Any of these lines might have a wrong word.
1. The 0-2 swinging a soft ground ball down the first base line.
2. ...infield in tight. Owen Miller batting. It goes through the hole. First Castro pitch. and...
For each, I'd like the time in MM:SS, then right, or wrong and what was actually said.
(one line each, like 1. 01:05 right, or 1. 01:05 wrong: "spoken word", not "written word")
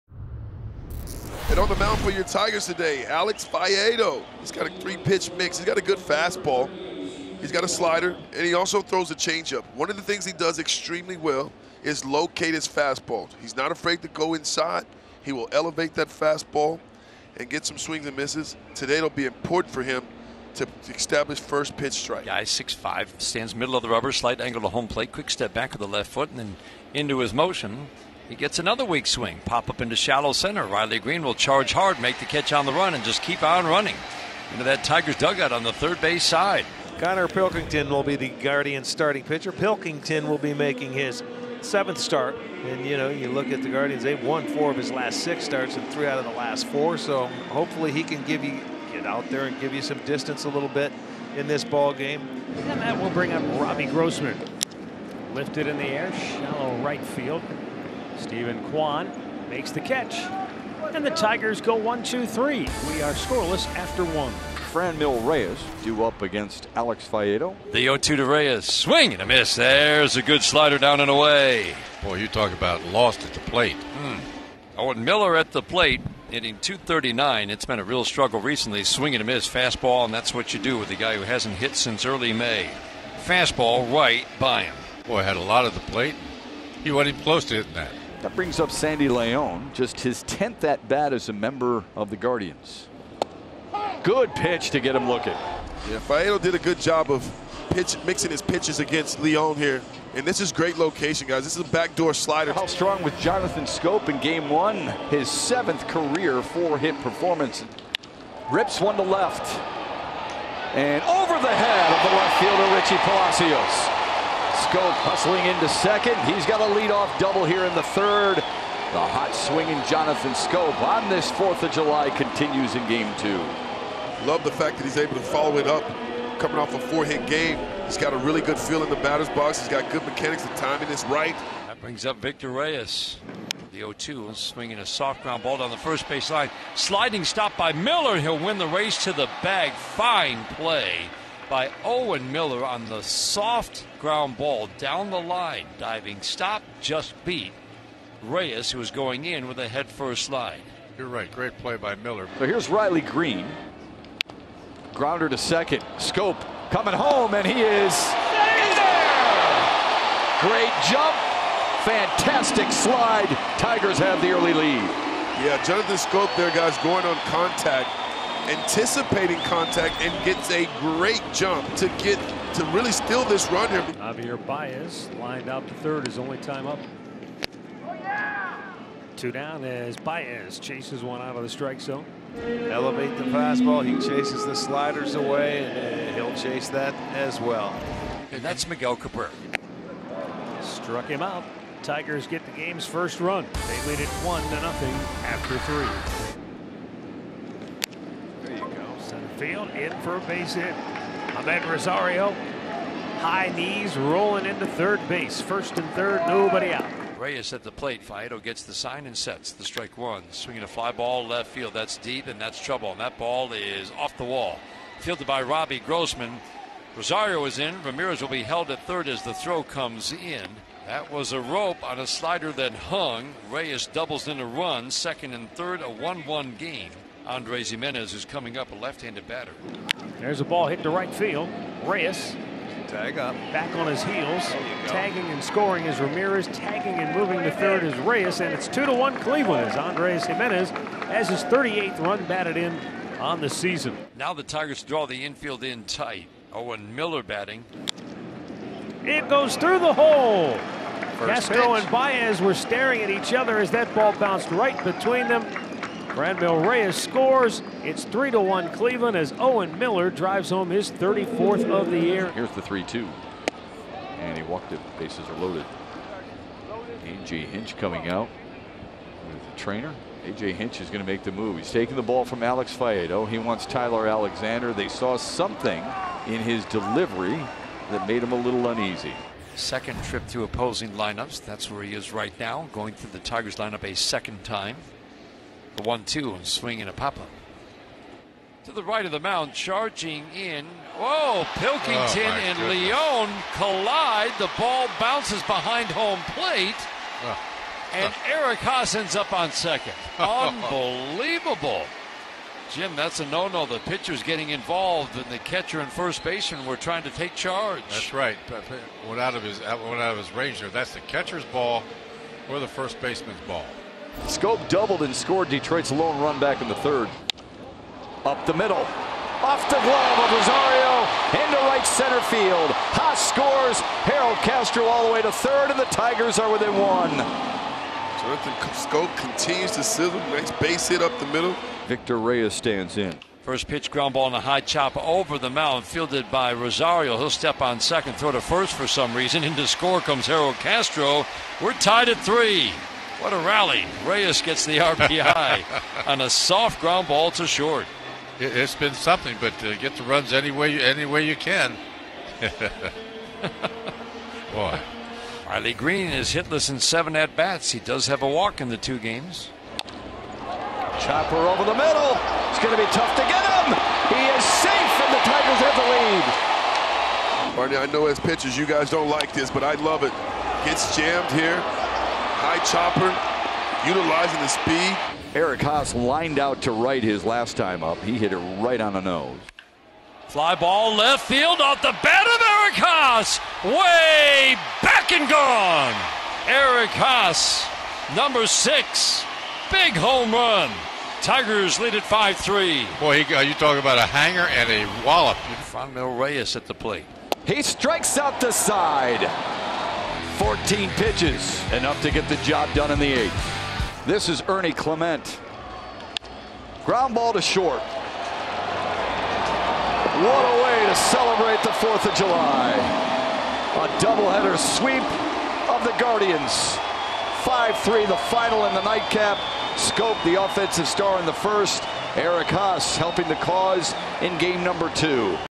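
1. 02:13 right
2. 04:05 right.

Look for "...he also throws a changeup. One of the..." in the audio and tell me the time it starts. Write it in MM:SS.
00:08.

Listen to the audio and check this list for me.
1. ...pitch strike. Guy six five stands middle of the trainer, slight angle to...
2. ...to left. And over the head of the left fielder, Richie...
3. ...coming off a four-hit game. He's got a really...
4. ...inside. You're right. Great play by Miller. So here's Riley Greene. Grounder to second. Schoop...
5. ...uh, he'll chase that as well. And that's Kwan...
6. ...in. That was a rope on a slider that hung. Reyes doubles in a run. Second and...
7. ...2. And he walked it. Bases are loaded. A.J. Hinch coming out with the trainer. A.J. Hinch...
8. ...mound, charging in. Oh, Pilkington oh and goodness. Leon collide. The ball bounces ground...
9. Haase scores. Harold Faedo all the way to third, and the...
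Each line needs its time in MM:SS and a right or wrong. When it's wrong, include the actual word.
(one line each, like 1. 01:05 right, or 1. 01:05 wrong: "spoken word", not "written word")
1. 00:21 wrong: "rubber", not "trainer"
2. 01:48 right
3. 02:06 right
4. 02:30 wrong: "slide", not "inside"
5. 03:06 wrong: "Miguel", not "Kwan"
6. 03:40 right
7. 04:22 right
8. 04:49 wrong: "behind", not "ground"
9. 05:22 wrong: "Castro", not "Faedo".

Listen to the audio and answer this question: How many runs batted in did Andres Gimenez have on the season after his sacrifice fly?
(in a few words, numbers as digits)
38.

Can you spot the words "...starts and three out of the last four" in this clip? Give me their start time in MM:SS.
00:45.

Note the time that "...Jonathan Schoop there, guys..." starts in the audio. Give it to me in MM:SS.
02:45.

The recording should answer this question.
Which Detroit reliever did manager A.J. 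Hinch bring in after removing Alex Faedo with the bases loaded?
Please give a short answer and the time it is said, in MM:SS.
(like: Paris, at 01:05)
Tyler Alexander, at 04:33.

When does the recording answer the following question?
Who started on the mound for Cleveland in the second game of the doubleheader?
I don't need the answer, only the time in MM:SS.
00:36.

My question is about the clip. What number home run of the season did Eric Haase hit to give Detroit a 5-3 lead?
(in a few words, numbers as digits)
6.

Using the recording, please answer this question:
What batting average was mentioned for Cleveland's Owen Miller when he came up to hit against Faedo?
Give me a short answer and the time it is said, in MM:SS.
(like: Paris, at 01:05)
.239, at 01:16.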